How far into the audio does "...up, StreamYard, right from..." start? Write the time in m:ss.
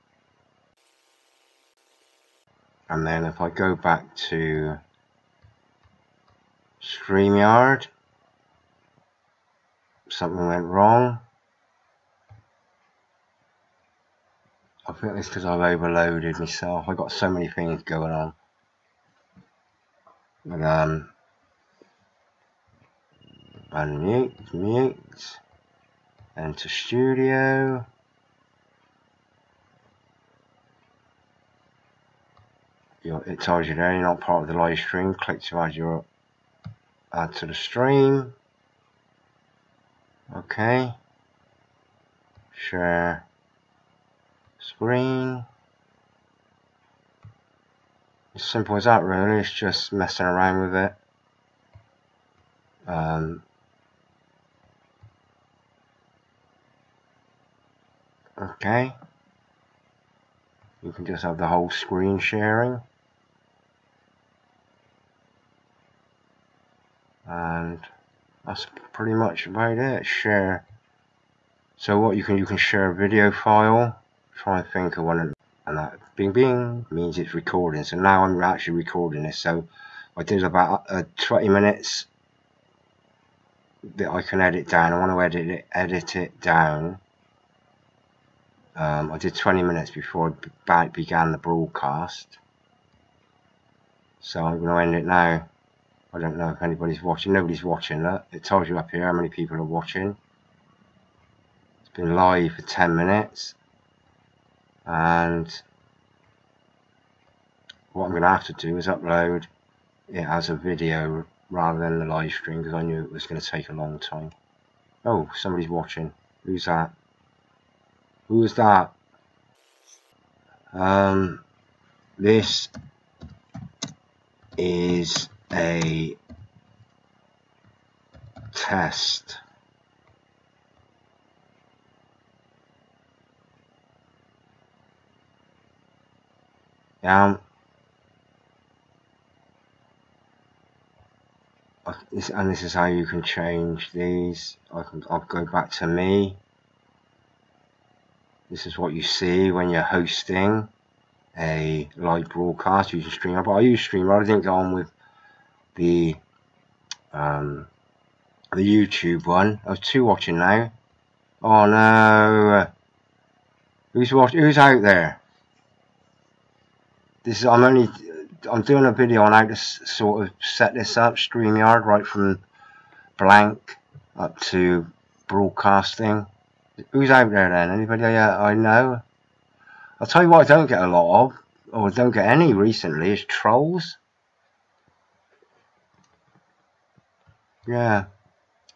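2:50.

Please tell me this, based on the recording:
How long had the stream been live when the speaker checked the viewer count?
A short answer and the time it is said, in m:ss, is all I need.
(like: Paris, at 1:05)
10 minutes, at 1:42.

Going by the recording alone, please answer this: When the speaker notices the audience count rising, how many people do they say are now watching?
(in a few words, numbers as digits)
2.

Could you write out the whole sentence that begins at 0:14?
I think it's because I've overloaded myself.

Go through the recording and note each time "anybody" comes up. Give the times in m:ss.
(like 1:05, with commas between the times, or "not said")
1:36, 2:57.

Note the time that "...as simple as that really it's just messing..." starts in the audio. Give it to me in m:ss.
0:48.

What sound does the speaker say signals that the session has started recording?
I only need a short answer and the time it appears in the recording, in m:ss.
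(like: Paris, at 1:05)
bing bing, at 1:16.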